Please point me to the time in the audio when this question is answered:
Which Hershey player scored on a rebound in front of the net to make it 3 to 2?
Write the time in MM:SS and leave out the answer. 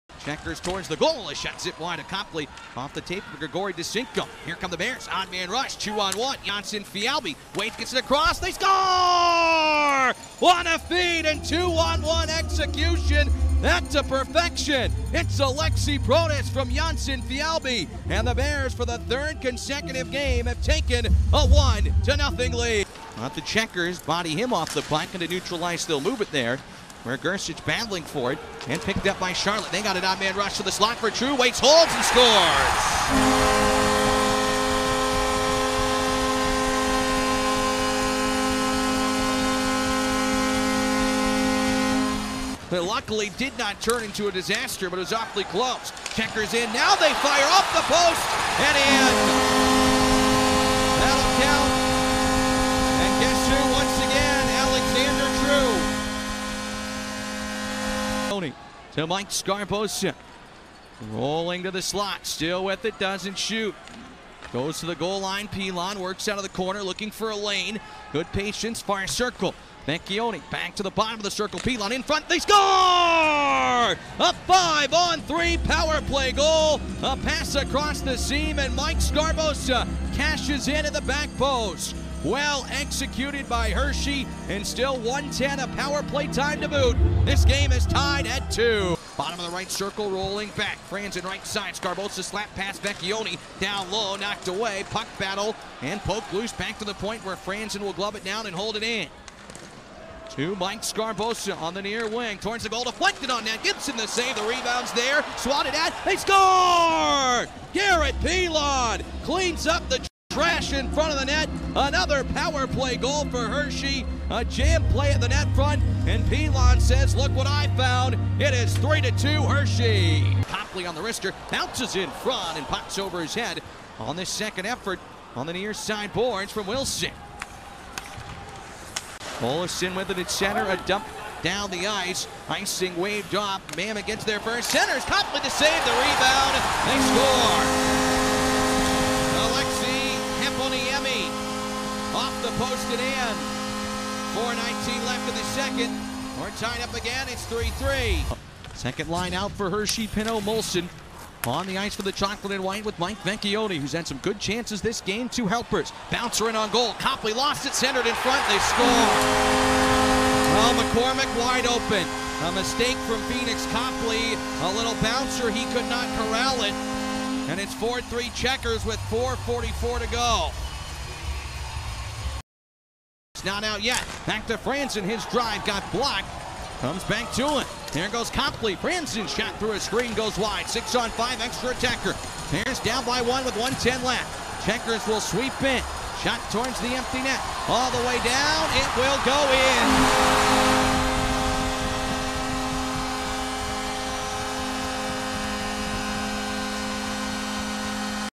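01:47.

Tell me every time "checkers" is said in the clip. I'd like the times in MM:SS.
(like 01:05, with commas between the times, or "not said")
00:00, 00:23, 00:46, 02:48, 03:04.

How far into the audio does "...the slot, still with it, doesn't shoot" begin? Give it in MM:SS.
01:01.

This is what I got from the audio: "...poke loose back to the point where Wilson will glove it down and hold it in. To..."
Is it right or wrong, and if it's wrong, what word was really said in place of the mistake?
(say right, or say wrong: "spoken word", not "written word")
wrong: "Franson", not "Wilson".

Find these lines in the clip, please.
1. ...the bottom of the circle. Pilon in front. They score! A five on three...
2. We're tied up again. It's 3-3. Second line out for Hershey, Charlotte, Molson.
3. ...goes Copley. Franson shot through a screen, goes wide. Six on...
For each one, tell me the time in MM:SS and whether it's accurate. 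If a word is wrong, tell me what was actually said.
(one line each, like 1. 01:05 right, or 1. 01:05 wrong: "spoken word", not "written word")
1. 01:10 right
2. 02:26 wrong: "Pinho", not "Charlotte"
3. 02:58 right.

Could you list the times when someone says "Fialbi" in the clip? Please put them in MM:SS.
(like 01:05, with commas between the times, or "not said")
00:06, 00:17.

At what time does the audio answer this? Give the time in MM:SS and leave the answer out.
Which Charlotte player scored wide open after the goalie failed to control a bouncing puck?
02:40.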